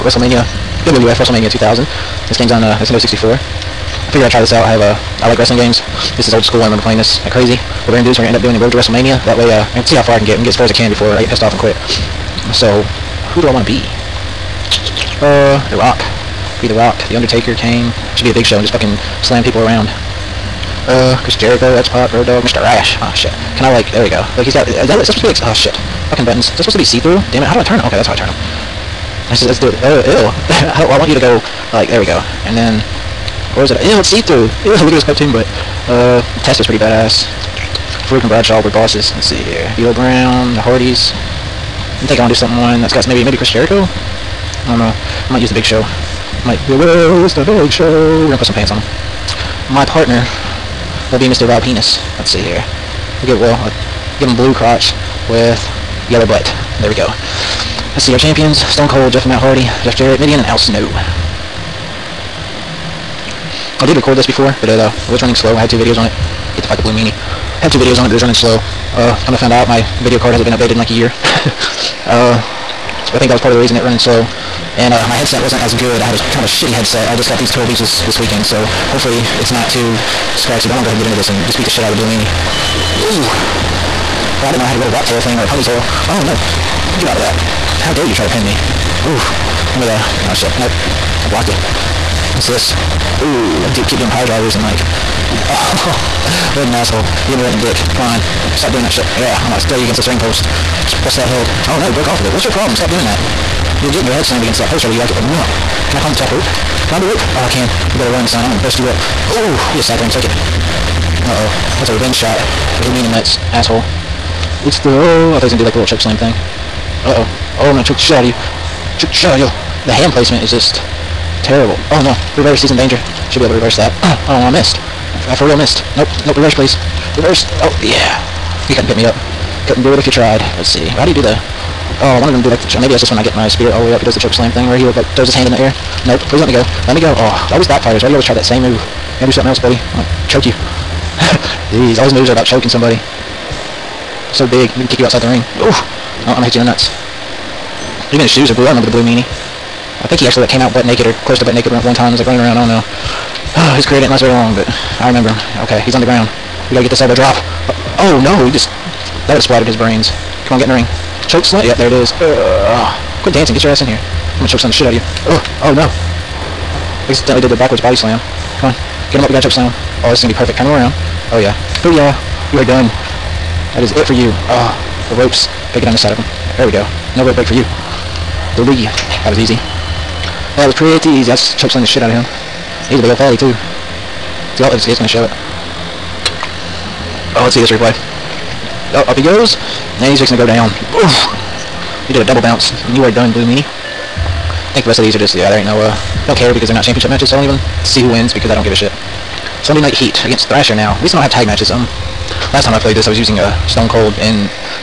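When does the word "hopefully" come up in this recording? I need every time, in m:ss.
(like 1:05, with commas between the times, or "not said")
1:18.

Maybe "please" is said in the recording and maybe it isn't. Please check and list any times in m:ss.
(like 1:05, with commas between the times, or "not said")
2:06, 2:16.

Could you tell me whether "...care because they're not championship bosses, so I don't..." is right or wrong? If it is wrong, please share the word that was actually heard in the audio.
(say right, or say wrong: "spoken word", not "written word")
wrong: "matches", not "bosses".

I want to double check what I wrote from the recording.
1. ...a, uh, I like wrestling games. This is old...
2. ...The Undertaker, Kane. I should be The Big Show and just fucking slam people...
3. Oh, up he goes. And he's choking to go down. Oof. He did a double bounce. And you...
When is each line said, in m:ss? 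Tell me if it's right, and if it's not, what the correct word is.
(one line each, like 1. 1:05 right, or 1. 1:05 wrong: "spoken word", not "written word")
1. 0:04 right
2. 0:17 right
3. 3:08 wrong: "fixing", not "choking".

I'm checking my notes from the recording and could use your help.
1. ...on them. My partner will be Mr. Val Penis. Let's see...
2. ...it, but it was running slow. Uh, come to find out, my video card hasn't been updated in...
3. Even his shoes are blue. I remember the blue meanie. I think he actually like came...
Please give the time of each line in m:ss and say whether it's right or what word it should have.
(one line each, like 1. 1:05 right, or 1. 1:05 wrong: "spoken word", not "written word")
1. 0:48 right
2. 1:08 right
3. 2:28 right.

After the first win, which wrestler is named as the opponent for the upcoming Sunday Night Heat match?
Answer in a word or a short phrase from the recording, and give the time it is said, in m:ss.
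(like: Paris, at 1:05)
Thrasher, at 3:20.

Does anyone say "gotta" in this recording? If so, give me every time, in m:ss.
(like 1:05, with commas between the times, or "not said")
2:19, 2:36, 2:55.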